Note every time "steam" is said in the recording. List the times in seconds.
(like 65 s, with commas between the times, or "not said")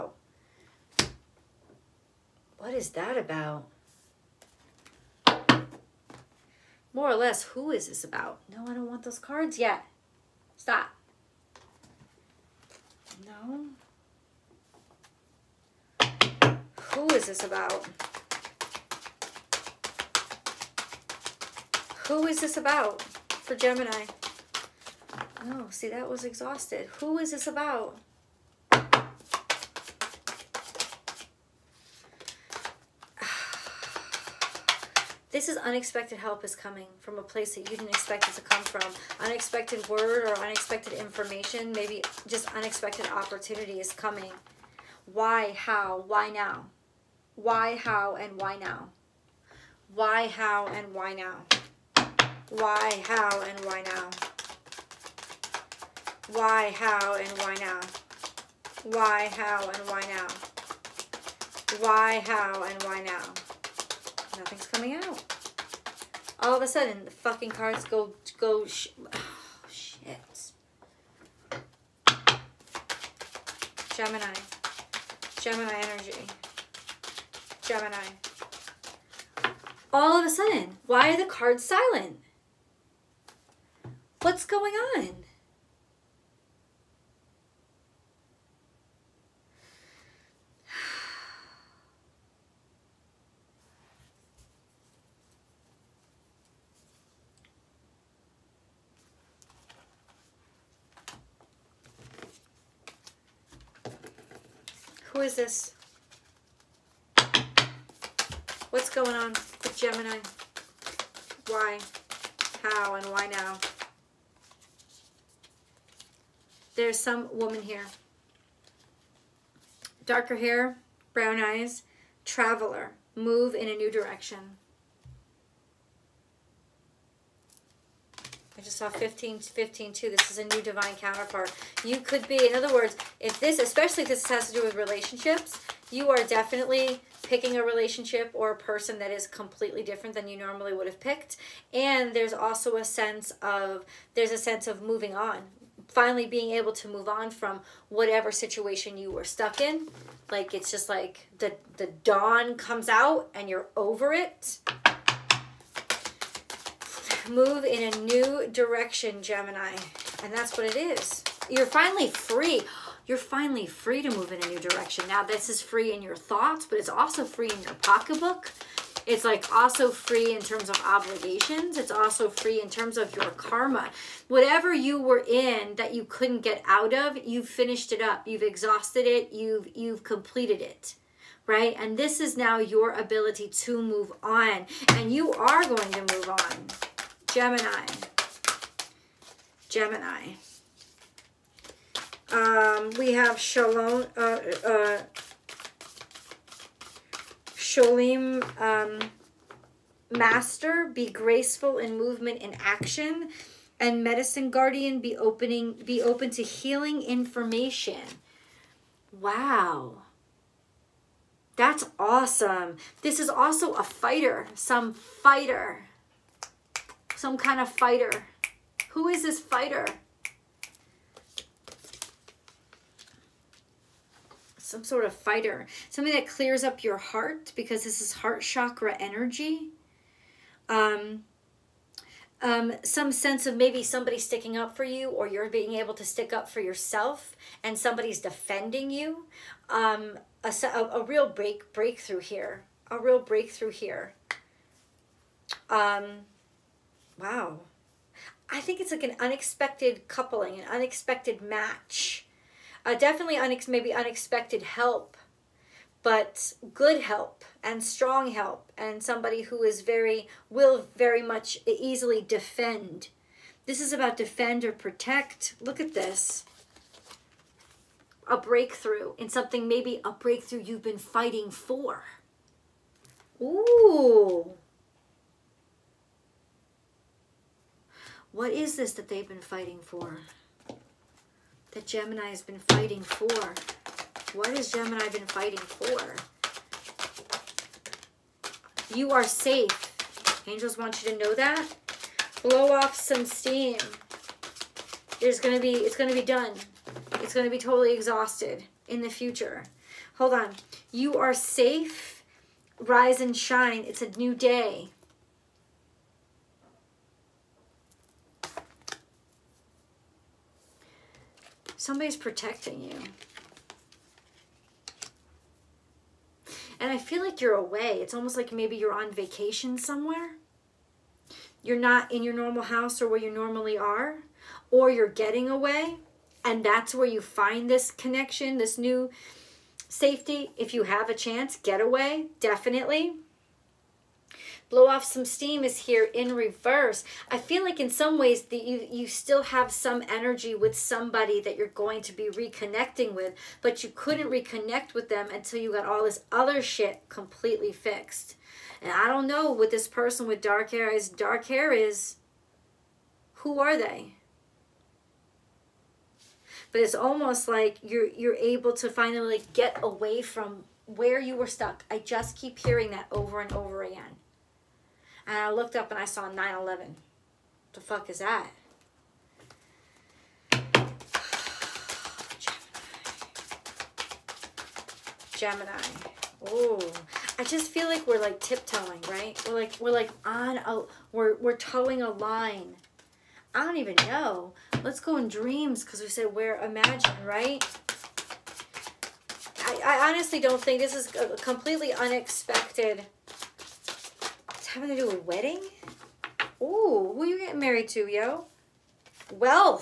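293 s, 335 s.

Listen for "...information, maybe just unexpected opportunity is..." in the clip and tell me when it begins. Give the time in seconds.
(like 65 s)
40 s.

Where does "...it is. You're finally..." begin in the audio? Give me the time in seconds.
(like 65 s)
160 s.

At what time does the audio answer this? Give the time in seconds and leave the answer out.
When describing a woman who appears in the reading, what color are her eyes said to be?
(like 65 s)
121 s.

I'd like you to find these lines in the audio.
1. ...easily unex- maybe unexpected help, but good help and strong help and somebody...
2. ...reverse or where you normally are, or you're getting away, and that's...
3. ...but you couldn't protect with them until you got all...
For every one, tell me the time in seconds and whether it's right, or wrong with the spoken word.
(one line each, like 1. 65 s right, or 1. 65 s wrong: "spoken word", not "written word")
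1. 252 s wrong: "definitely", not "easily"
2. 322 s wrong: "house", not "reverse"
3. 343 s wrong: "reconnect", not "protect".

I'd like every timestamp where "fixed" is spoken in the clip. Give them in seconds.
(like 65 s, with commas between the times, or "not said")
347 s.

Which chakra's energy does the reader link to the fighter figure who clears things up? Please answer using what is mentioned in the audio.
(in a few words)
Heart chakra.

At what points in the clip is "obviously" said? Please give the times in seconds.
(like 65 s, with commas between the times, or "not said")
not said.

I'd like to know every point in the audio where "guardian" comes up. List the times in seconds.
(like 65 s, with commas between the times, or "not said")
204 s.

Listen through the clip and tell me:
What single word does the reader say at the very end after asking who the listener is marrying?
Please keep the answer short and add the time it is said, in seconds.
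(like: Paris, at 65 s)
Wealth, at 399 s.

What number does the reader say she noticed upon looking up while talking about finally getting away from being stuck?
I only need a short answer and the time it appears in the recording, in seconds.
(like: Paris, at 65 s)
9-11, at 366 s.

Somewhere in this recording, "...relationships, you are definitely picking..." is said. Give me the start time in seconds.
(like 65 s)
134 s.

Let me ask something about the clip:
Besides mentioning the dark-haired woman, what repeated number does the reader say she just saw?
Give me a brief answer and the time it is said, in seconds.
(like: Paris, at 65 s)
15, at 128 s.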